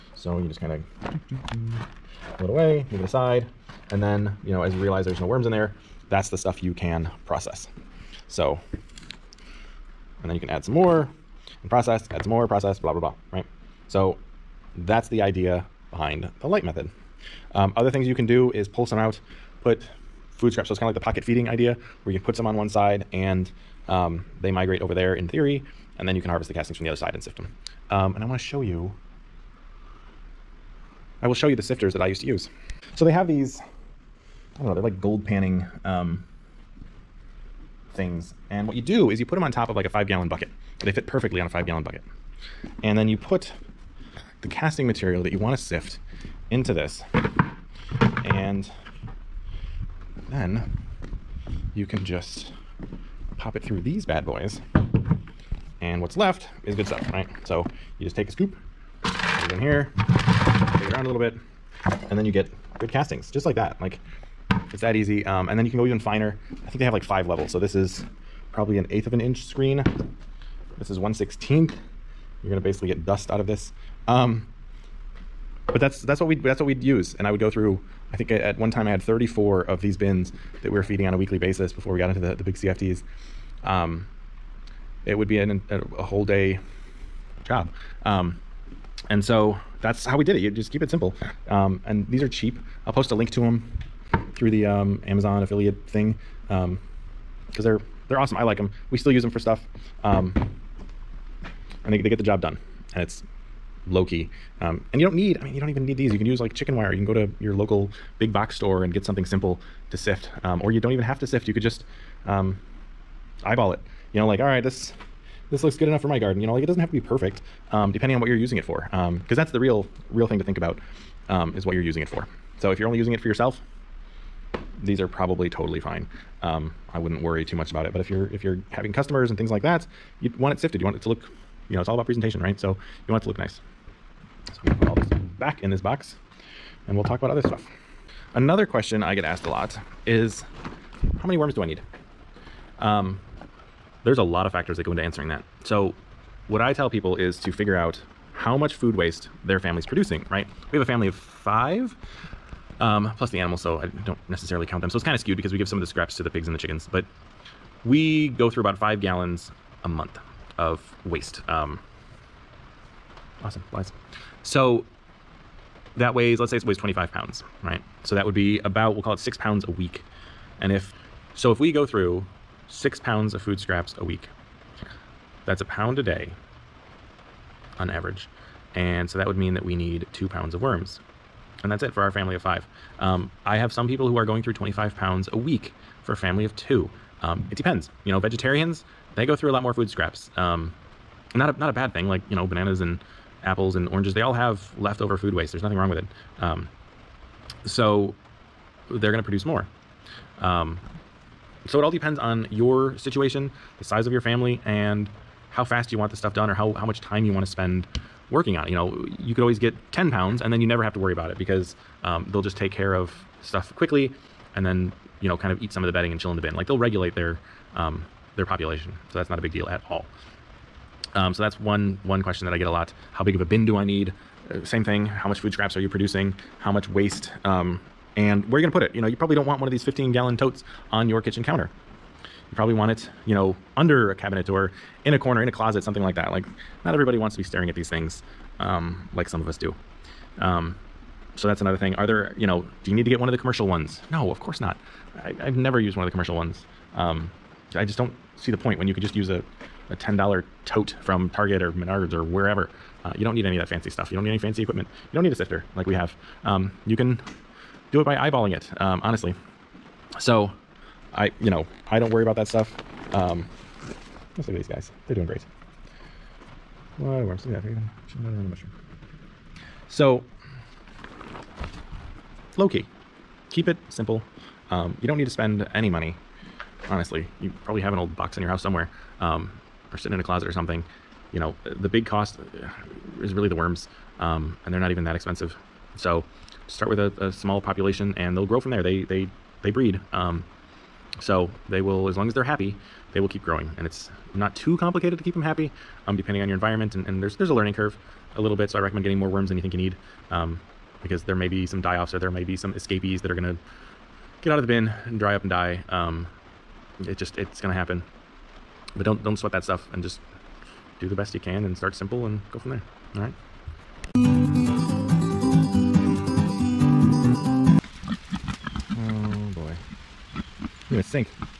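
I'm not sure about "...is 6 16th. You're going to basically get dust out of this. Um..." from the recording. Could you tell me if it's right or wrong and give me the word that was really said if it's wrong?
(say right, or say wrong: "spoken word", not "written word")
wrong: "1", not "6".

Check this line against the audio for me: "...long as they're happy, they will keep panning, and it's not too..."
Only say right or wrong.
wrong.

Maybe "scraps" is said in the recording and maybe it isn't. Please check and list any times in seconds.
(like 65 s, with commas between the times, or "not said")
20 s, 155 s, 173 s, 189 s, 225 s.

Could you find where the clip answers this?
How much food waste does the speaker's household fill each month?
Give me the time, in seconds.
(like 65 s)
158 s.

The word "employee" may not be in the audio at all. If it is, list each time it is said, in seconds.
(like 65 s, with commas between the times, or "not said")
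not said.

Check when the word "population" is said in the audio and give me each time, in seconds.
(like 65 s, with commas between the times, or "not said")
218 s, 287 s.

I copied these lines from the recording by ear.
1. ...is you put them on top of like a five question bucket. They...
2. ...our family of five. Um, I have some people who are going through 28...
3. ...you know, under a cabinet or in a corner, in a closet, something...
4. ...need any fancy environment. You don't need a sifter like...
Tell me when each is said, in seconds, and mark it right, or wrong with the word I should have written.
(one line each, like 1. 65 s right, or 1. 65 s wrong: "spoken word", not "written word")
1. 39 s wrong: "gallon", not "question"
2. 182 s wrong: "25", not "28"
3. 233 s right
4. 254 s wrong: "equipment", not "environment".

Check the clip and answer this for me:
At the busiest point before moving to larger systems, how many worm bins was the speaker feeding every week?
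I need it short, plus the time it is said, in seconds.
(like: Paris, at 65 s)
34, at 79 s.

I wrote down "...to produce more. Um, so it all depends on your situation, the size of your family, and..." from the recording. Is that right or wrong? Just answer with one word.
right.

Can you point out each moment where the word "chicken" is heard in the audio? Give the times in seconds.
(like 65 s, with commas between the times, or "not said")
106 s, 156 s.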